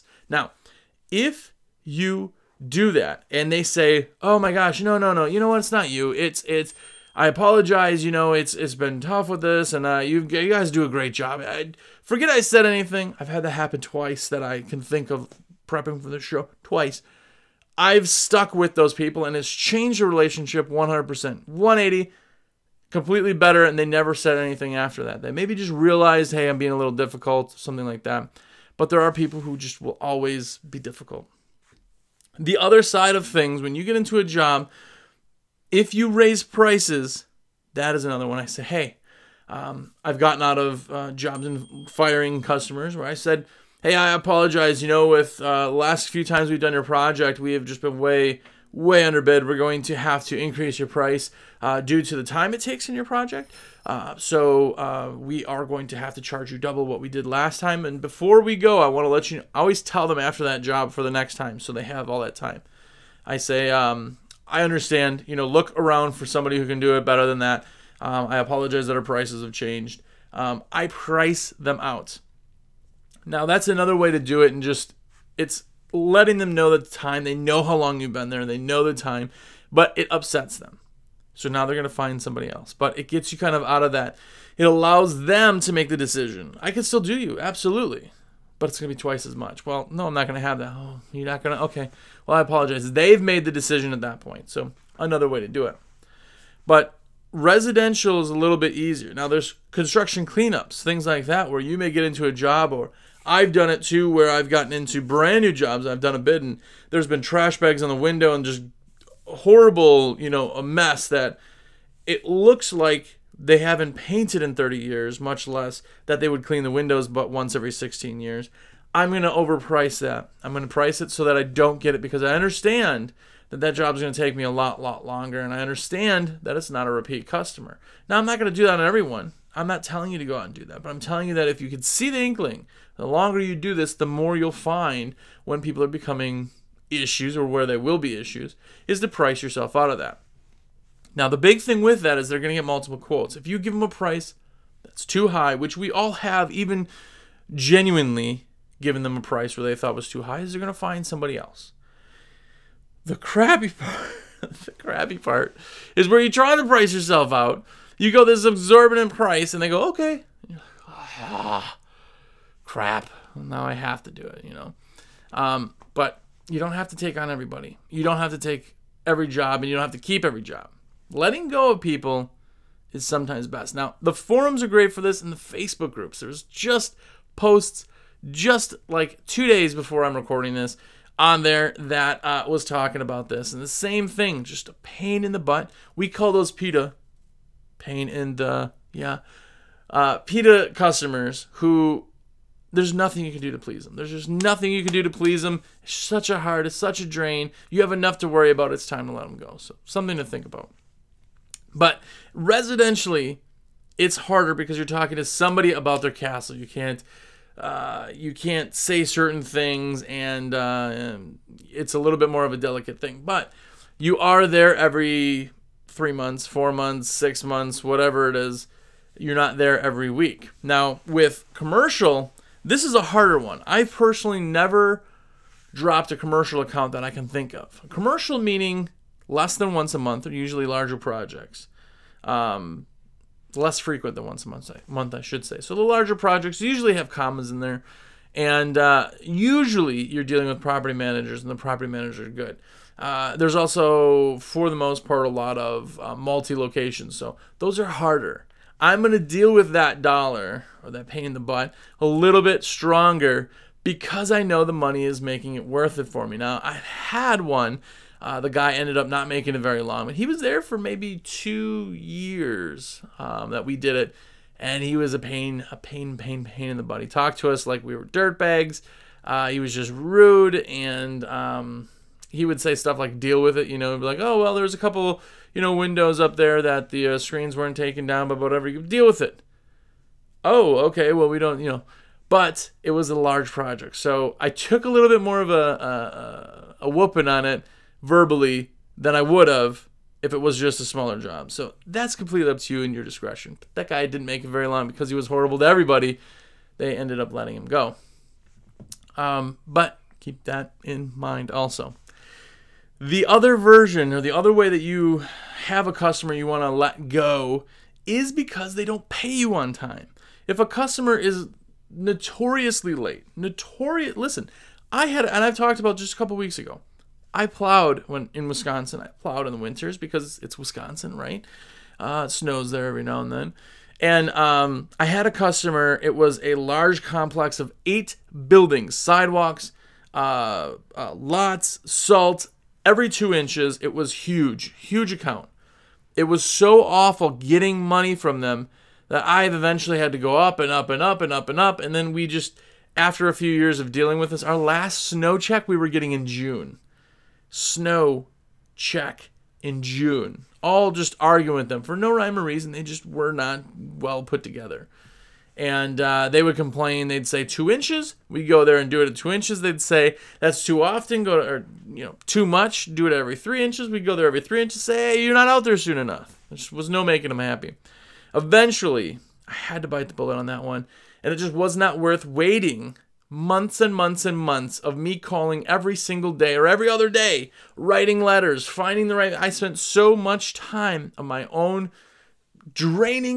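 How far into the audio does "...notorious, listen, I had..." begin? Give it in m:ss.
5:13.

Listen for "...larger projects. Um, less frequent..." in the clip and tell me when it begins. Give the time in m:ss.
3:50.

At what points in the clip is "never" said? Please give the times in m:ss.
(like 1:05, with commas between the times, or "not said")
0:23, 3:44.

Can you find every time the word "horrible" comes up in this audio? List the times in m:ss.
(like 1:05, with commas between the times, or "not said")
1:49, 4:55.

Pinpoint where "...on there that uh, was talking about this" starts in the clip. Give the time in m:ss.
3:01.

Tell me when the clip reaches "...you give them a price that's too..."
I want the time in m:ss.
2:23.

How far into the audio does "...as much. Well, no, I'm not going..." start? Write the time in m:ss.
1:29.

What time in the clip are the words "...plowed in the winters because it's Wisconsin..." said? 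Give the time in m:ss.
5:19.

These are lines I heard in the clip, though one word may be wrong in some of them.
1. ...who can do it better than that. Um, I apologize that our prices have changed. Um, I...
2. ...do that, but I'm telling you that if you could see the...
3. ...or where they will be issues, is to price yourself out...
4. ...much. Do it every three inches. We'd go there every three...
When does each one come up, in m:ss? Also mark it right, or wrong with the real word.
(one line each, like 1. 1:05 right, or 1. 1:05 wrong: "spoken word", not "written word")
1. 1:06 right
2. 2:10 right
3. 2:17 right
4. 6:02 right.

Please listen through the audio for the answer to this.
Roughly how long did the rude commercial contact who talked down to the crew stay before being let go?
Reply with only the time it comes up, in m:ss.
4:20.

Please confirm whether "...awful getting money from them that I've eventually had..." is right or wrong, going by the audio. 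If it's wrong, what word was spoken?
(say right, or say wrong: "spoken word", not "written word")
right.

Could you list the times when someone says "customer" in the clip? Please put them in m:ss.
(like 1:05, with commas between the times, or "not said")
0:42, 2:07, 3:10, 5:05, 5:10, 5:25.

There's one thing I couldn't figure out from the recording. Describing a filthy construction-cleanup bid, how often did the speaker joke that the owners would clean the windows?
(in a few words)
once every 16 years.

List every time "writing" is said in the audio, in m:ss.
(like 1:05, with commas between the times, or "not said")
6:17.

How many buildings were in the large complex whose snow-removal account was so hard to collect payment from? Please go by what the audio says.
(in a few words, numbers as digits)
8.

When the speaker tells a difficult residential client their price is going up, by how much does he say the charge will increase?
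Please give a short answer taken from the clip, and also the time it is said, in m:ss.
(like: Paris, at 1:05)
double, at 0:56.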